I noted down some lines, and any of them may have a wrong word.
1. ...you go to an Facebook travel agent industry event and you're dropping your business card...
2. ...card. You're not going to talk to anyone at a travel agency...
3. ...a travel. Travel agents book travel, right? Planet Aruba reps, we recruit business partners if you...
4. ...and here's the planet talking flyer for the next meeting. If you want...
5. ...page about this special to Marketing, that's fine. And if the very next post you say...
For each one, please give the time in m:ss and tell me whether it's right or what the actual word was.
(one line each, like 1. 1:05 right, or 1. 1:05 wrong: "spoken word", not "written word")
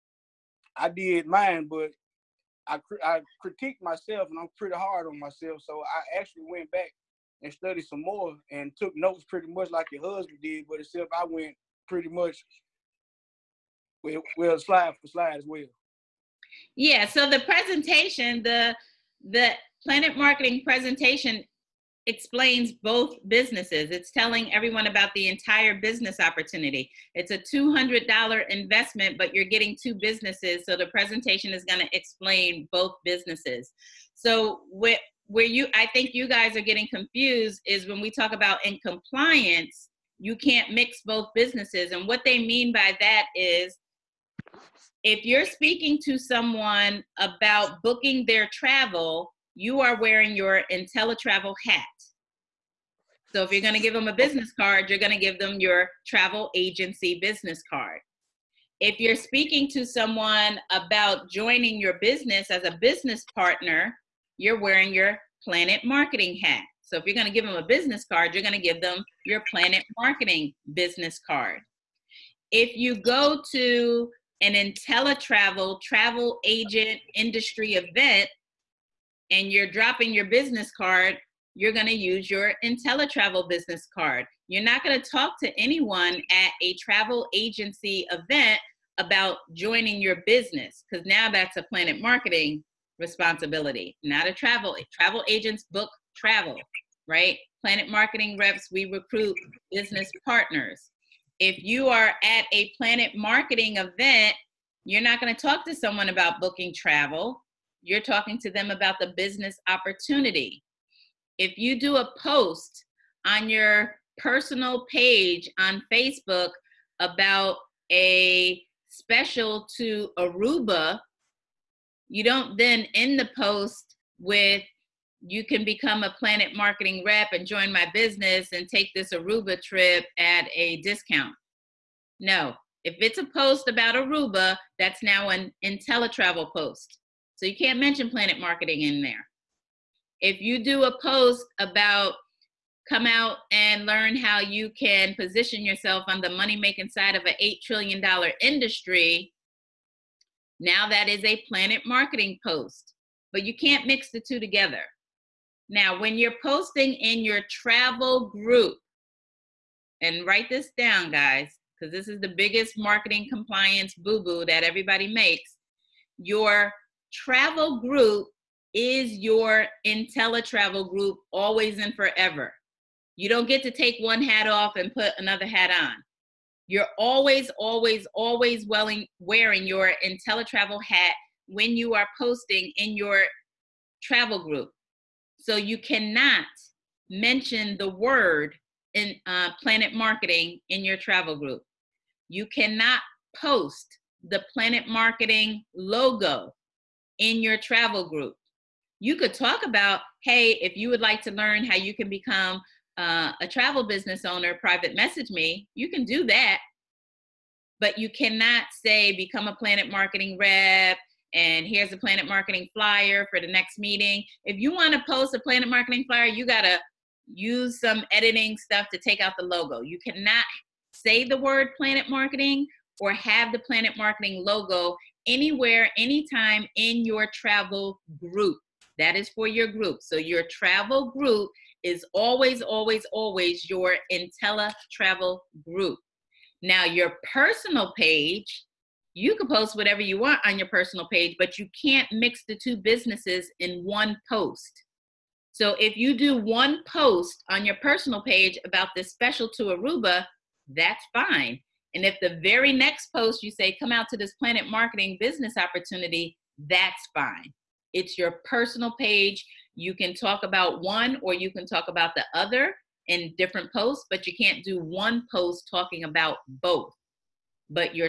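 1. 1:12 wrong: "InteleTravel", not "Facebook"
2. 1:23 right
3. 1:34 wrong: "Marketing", not "Aruba"
4. 3:31 wrong: "marketing", not "talking"
5. 4:08 wrong: "Aruba", not "Marketing".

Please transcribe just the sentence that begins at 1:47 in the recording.
You're talking to them about the business opportunity.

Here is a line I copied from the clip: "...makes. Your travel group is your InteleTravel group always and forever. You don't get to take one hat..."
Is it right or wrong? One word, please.
right.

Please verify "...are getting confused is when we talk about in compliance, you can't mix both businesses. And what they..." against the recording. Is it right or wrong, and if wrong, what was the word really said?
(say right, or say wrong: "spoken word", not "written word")
right.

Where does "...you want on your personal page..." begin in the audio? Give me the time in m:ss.
4:00.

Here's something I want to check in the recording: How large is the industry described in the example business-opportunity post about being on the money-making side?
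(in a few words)
$8 trillion.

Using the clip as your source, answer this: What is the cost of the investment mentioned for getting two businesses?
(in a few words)
$200.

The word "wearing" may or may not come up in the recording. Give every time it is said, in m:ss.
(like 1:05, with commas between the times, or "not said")
0:50, 1:04, 2:58.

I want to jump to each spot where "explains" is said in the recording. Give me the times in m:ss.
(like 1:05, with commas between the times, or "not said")
0:22, 0:31.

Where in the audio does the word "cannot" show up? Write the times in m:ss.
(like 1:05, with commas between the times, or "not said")
3:05, 3:12, 3:28, 3:40.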